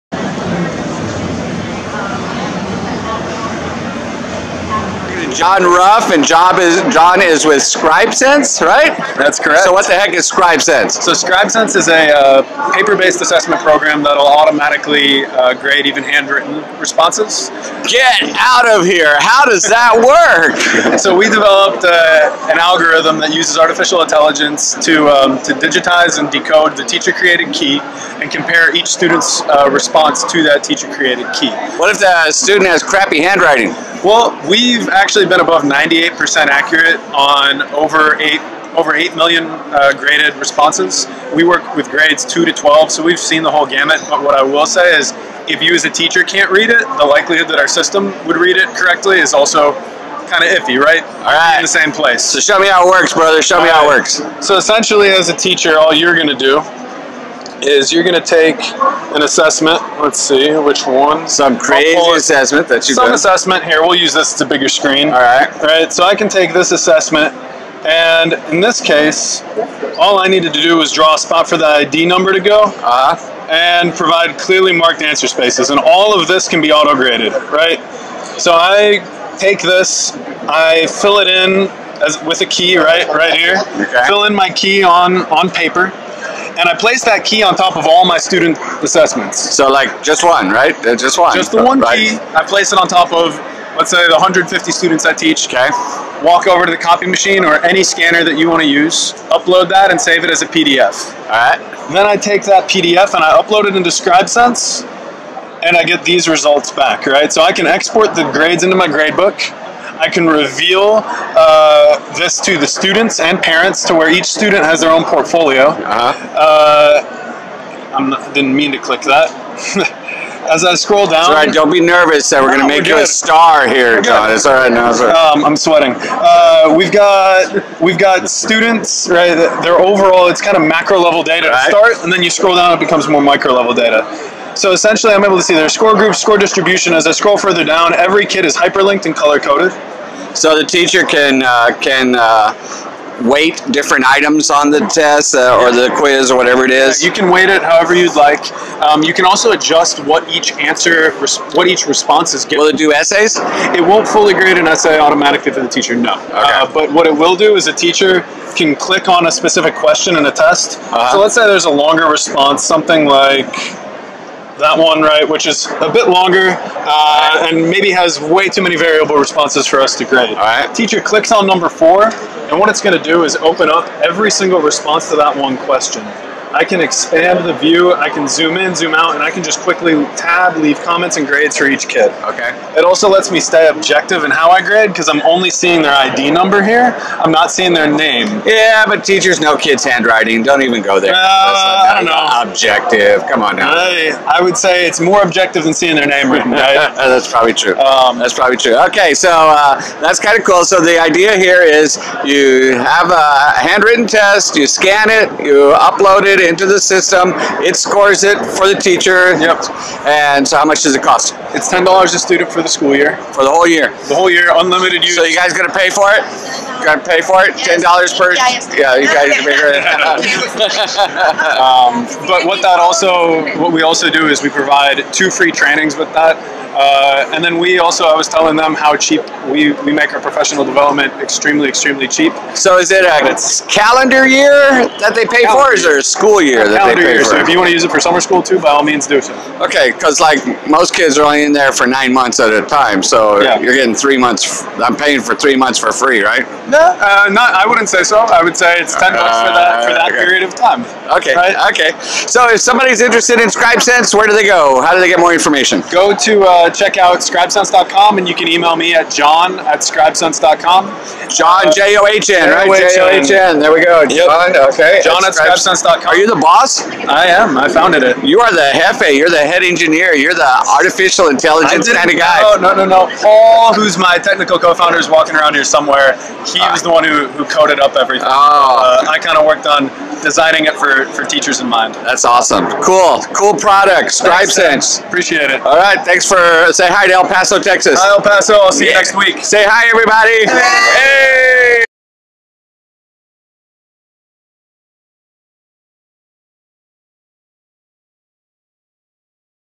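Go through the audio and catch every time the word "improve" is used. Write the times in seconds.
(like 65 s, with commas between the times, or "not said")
not said.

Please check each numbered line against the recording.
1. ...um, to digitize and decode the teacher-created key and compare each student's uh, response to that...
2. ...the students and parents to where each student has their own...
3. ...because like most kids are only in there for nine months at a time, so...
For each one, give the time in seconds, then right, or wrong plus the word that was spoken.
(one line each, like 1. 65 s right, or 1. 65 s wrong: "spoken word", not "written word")
1. 25 s right
2. 112 s right
3. 239 s right.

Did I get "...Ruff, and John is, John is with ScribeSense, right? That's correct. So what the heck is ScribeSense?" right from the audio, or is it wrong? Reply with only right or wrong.
right.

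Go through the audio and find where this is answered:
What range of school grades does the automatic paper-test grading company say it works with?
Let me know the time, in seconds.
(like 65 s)
41 s.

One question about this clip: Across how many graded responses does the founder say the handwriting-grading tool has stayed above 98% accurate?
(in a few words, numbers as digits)
8 million.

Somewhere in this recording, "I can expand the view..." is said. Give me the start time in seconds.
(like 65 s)
176 s.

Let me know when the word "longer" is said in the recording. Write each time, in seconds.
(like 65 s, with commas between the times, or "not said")
161 s, 166 s.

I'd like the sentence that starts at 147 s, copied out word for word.
Yeah, you can weight it however you'd like.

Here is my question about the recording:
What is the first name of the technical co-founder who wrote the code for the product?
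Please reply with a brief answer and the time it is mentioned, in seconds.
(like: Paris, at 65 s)
Paul, at 273 s.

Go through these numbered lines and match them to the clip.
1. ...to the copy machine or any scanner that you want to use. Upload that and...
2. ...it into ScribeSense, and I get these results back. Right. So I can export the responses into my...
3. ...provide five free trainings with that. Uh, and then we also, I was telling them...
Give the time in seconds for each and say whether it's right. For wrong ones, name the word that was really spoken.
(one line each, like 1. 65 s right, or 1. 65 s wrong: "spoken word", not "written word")
1. 96 s right
2. 103 s wrong: "grades", not "responses"
3. 224 s wrong: "two", not "five".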